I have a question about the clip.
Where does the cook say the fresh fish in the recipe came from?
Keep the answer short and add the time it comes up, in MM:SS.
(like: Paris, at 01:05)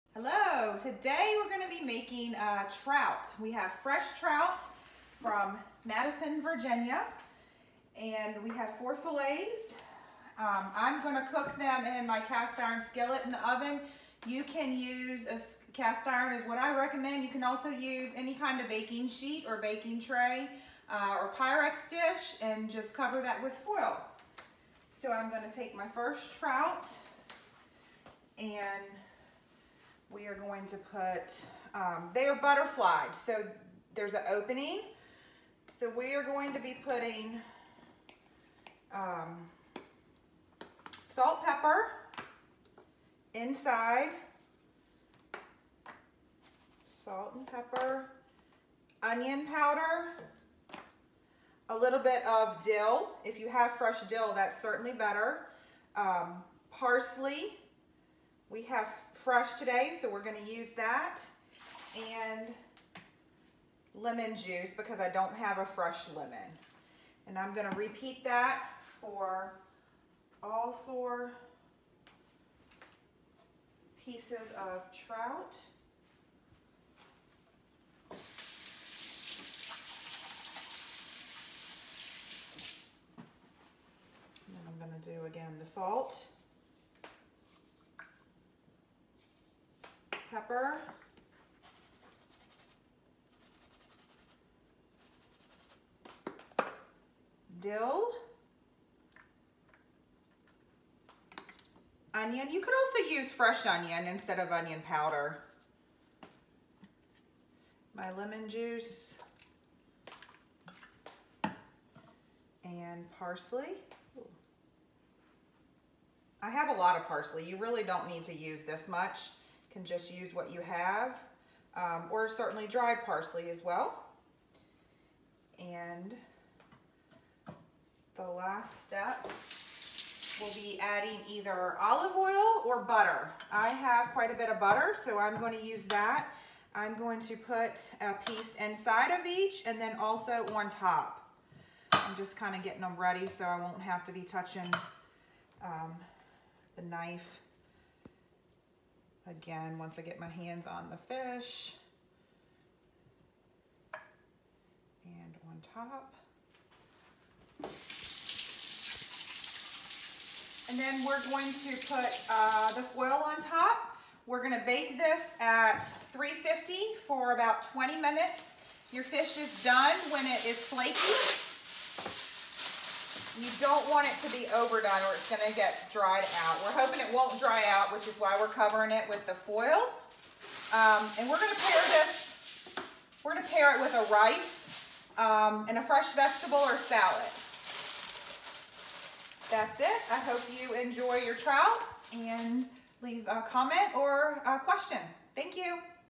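Madison, Virginia, at 00:05.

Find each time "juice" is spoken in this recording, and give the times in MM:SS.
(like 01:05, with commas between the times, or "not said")
01:04, 01:48.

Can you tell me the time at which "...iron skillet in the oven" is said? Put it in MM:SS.
00:12.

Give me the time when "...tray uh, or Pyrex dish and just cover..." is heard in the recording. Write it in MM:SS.
00:20.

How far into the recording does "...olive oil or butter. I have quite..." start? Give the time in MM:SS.
02:11.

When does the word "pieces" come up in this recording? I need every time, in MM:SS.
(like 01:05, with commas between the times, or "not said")
01:14, 02:18.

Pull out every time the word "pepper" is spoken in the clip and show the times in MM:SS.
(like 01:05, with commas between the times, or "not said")
00:41, 00:47, 01:30.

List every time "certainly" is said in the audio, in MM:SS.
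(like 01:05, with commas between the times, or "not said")
00:54, 02:02.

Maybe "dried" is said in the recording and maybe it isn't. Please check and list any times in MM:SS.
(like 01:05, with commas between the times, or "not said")
02:02, 02:55.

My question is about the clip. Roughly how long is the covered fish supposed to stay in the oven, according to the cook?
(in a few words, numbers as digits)
20 minutes.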